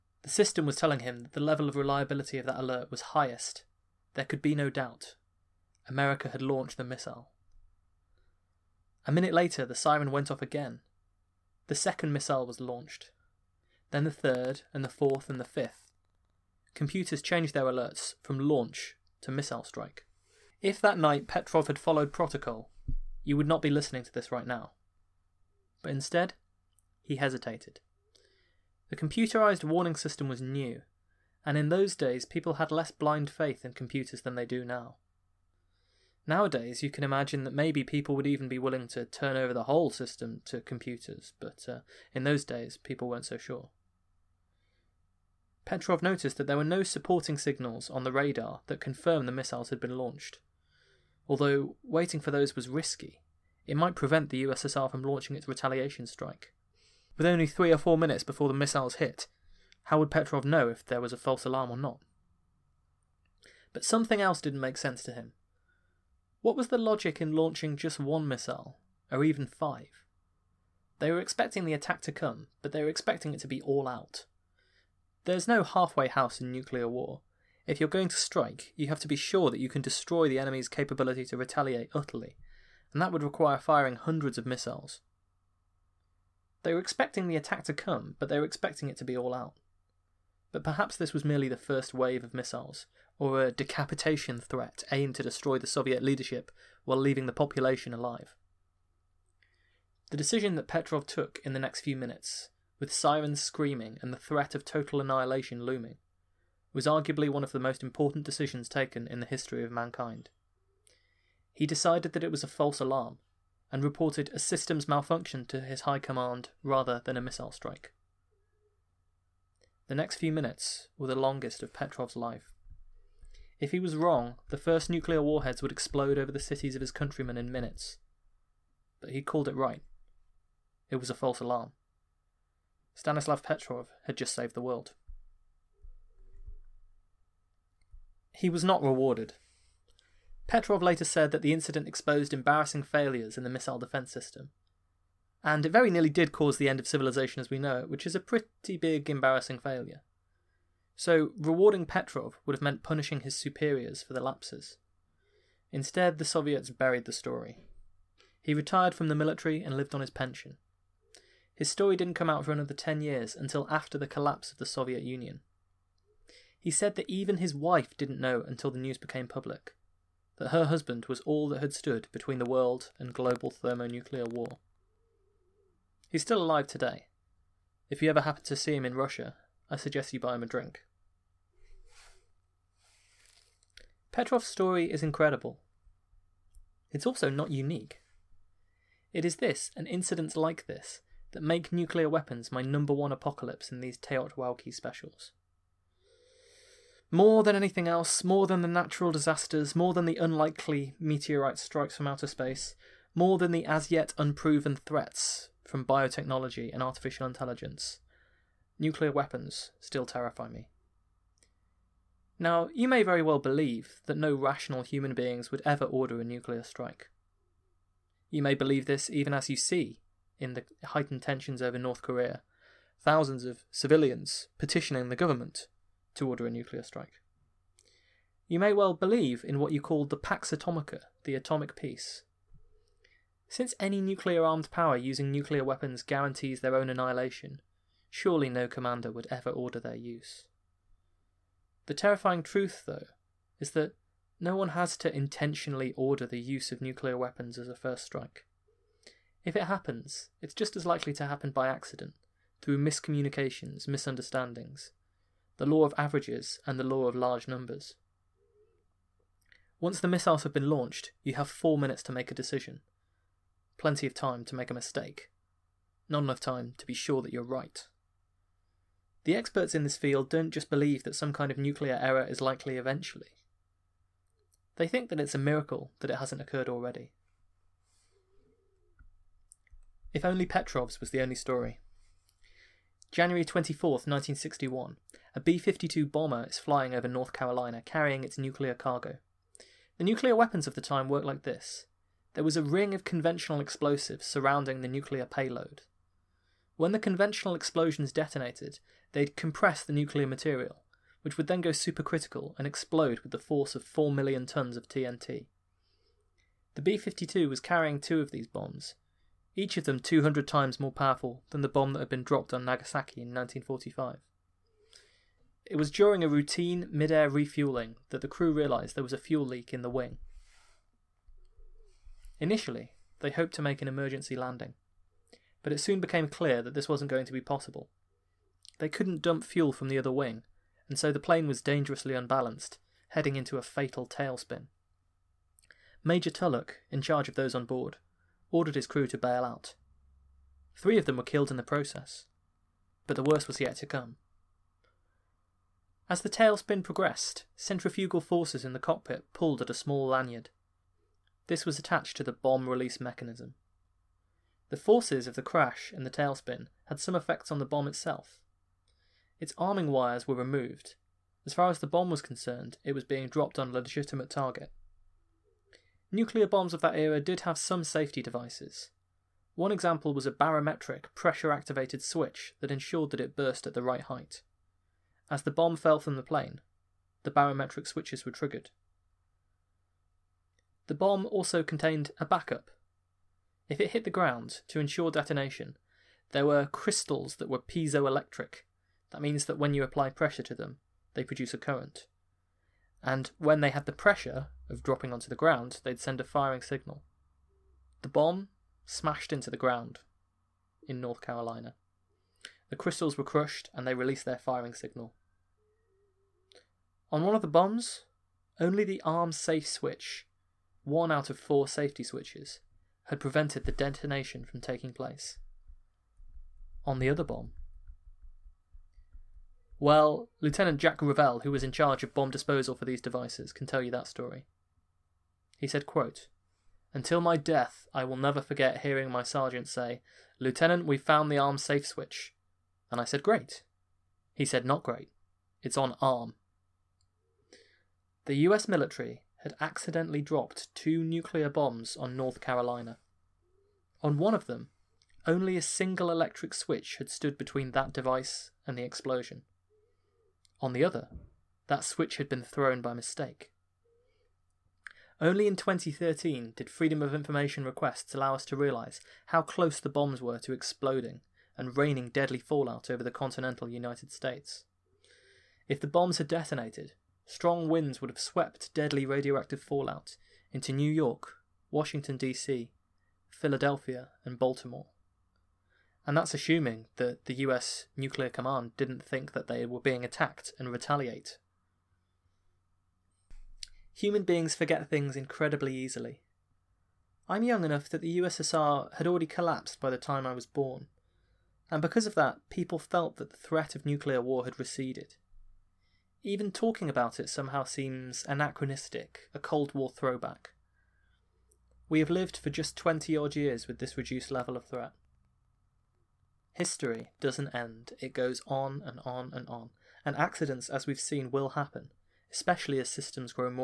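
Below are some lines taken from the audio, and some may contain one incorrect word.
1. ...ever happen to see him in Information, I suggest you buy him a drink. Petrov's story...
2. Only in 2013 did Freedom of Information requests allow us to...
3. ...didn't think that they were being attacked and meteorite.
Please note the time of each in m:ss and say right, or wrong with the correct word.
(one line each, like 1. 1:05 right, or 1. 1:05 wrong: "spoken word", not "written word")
1. 2:58 wrong: "Russia", not "Information"
2. 7:35 right
3. 7:58 wrong: "retaliate", not "meteorite".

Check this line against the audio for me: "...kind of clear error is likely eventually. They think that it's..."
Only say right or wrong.
wrong.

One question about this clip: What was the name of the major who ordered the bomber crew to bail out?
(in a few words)
Major Tulloch.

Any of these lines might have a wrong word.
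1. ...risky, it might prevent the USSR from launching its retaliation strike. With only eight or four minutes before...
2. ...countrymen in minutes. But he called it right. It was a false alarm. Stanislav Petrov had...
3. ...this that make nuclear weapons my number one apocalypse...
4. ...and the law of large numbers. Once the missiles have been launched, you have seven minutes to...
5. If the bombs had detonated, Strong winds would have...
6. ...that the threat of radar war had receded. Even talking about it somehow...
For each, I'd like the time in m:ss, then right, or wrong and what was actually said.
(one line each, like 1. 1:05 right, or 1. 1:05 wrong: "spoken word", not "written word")
1. 0:52 wrong: "three", not "eight"
2. 2:06 right
3. 3:10 right
4. 4:16 wrong: "four", not "seven"
5. 7:45 right
6. 8:13 wrong: "nuclear", not "radar".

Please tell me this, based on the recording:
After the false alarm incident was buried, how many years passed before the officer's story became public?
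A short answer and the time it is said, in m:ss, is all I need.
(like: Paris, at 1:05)
10, at 2:42.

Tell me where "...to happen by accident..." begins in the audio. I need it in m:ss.
4:11.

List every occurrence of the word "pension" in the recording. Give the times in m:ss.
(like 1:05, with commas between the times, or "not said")
2:40.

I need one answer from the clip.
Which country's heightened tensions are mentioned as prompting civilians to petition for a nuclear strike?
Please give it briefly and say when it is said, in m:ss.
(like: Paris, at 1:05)
North Korea, at 3:41.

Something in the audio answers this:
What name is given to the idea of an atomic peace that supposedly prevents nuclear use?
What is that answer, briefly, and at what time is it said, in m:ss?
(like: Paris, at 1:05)
Pax Atomica, at 3:50.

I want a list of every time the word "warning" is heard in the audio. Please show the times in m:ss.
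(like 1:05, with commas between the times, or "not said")
0:29.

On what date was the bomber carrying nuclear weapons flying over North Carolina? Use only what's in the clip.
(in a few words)
January 24th, 1961.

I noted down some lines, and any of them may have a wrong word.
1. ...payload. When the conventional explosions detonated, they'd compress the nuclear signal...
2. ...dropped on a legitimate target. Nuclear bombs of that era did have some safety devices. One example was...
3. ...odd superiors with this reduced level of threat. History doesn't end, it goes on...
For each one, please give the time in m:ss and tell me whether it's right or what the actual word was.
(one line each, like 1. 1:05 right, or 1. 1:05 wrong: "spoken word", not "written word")
1. 4:55 wrong: "material", not "signal"
2. 6:03 right
3. 8:23 wrong: "years", not "superiors".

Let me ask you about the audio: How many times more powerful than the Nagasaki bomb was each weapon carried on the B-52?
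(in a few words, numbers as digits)
200.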